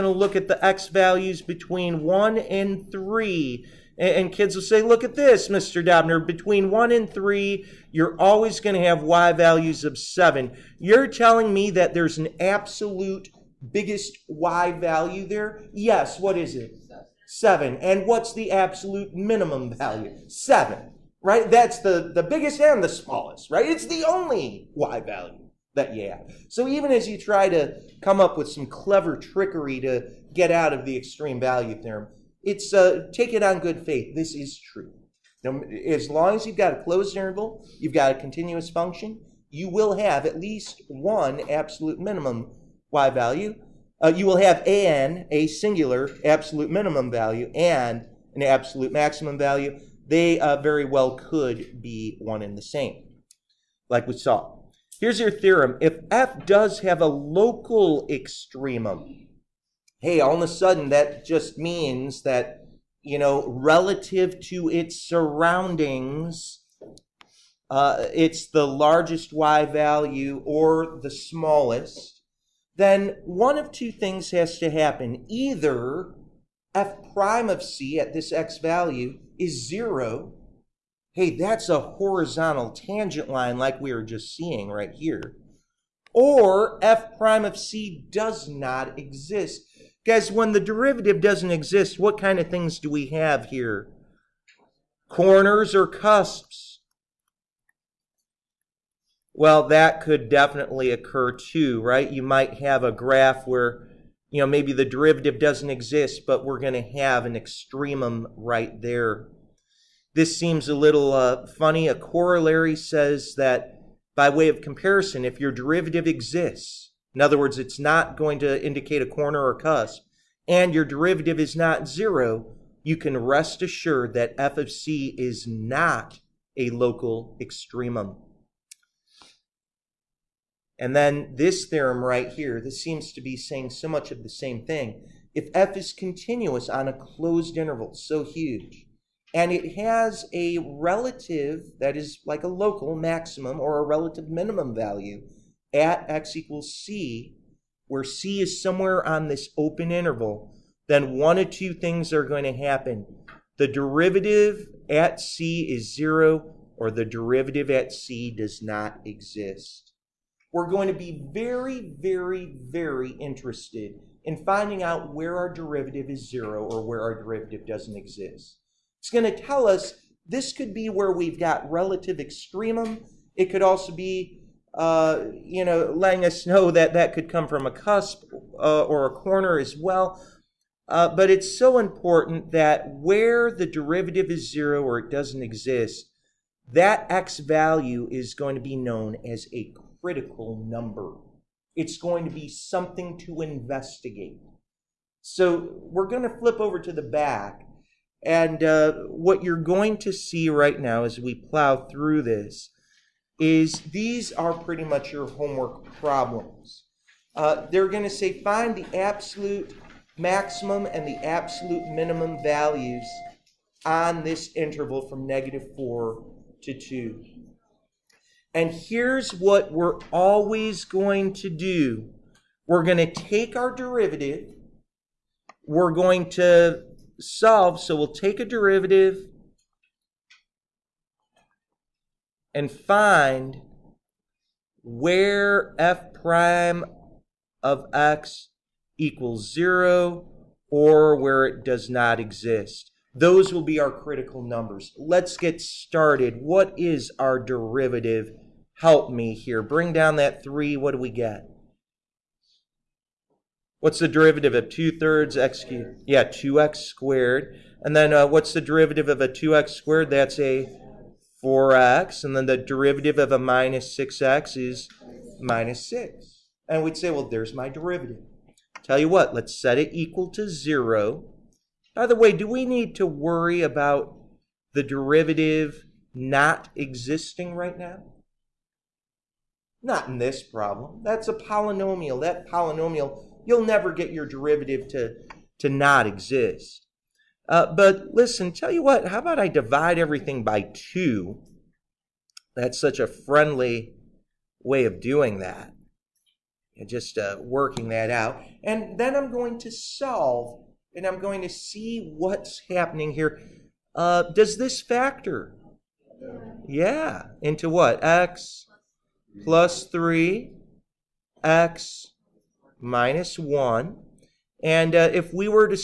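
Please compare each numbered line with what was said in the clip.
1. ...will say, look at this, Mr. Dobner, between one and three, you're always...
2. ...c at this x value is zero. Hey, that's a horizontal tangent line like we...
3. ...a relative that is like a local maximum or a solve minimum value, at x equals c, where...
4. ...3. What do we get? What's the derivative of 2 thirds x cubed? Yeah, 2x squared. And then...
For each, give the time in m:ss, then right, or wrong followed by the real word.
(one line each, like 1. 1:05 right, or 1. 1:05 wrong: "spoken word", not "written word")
1. 0:04 right
2. 1:17 right
3. 2:20 wrong: "relative", not "solve"
4. 4:10 right.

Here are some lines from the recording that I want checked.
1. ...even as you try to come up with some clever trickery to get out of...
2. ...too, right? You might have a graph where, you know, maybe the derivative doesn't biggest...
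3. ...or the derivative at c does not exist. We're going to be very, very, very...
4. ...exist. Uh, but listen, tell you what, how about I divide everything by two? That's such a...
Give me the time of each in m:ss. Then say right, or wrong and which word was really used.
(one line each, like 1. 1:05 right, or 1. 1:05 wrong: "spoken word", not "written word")
1. 0:26 right
2. 1:41 wrong: "exist", not "biggest"
3. 2:36 right
4. 4:46 right.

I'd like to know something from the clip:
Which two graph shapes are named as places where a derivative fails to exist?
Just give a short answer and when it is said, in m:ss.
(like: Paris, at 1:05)
Corners or cusps, at 1:35.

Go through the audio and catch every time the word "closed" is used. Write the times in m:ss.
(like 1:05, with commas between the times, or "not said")
0:36, 2:16.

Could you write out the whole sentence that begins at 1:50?
This seems a little uh, funny.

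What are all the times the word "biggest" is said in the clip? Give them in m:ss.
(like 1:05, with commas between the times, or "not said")
0:13, 0:22.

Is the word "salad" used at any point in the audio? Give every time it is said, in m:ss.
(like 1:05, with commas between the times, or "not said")
not said.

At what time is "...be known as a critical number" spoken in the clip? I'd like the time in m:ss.
3:08.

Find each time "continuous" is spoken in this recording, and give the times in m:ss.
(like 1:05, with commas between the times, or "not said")
0:38, 2:15.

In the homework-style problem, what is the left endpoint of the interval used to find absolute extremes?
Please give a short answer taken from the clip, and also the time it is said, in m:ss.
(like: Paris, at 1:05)
-4, at 3:35.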